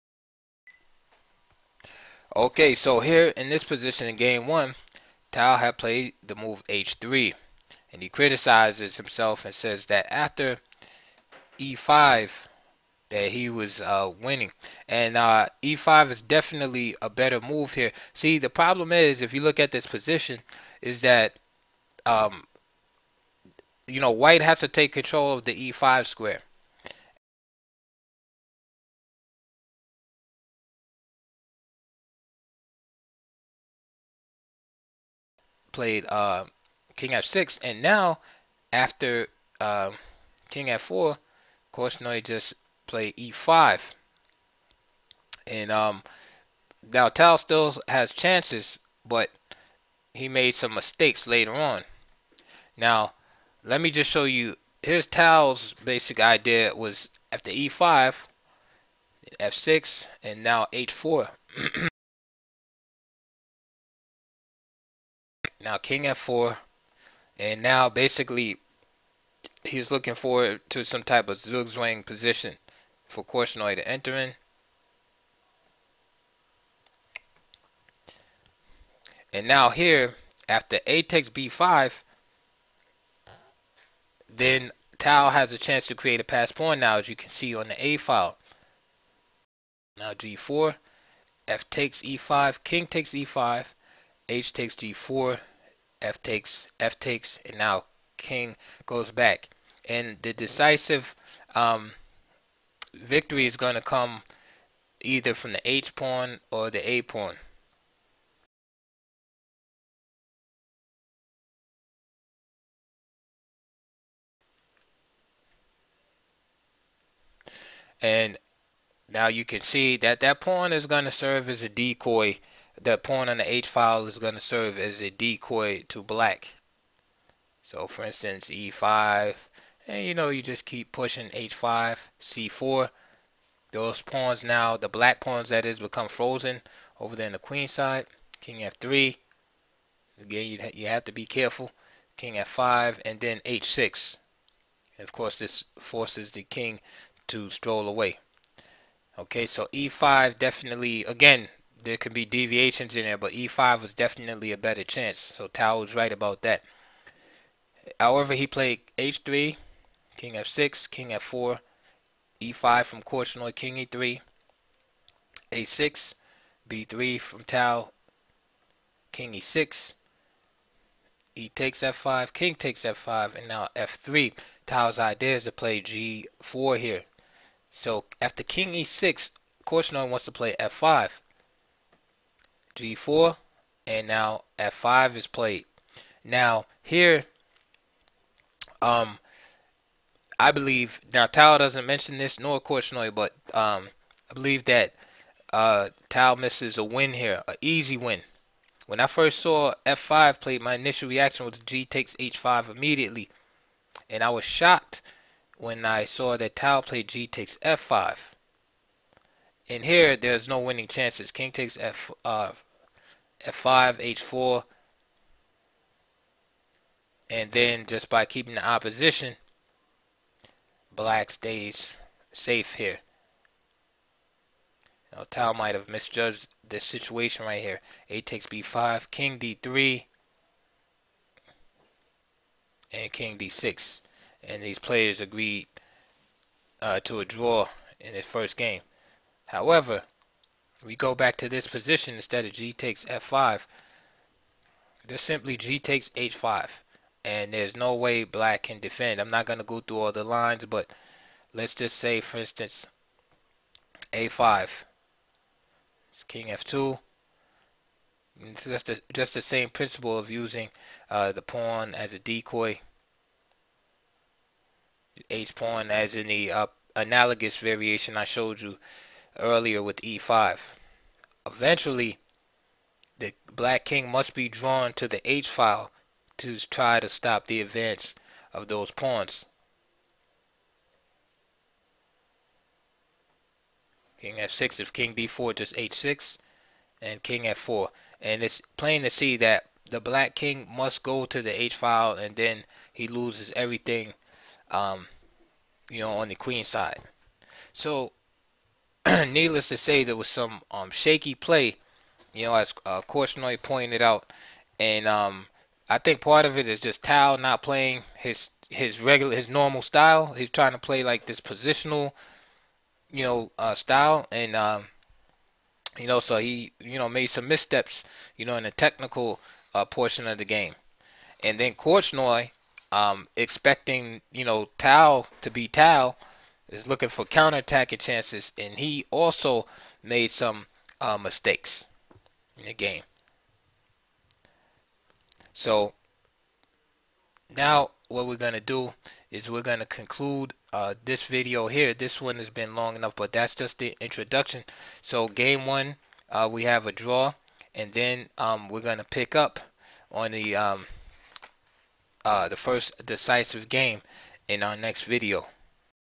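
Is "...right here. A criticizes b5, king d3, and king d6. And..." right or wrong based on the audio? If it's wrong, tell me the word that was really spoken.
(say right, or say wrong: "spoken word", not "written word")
wrong: "takes", not "criticizes".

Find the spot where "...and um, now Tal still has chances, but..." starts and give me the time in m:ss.
0:45.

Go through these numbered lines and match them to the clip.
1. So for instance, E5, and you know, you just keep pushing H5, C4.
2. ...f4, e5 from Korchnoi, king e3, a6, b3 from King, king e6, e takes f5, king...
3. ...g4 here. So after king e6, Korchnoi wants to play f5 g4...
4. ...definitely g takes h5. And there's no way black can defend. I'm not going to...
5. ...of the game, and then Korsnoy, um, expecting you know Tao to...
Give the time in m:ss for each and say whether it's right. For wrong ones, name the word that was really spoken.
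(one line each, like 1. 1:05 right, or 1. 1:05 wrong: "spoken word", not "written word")
1. 2:07 right
2. 2:41 wrong: "Tal", not "King"
3. 2:55 right
4. 4:05 wrong: "simply", not "definitely"
5. 5:20 right.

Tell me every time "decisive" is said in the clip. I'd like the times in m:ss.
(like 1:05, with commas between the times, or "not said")
1:40, 5:53.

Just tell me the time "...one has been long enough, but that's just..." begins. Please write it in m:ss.
5:42.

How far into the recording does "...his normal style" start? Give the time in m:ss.
5:09.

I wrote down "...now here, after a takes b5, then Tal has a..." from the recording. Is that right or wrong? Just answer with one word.
right.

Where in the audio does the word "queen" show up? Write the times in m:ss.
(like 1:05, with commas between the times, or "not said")
2:17, 4:56.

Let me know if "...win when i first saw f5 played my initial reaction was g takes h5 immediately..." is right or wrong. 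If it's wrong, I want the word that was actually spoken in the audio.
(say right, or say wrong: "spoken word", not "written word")
right.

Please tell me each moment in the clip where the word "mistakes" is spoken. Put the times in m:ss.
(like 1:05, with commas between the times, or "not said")
0:50, 5:31.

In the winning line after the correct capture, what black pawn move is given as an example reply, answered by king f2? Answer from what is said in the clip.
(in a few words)
a5.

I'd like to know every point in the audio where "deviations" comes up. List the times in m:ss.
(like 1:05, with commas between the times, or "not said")
2:32.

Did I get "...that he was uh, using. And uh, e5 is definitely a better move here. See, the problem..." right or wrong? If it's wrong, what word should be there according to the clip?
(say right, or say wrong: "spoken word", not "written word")
wrong: "winning", not "using".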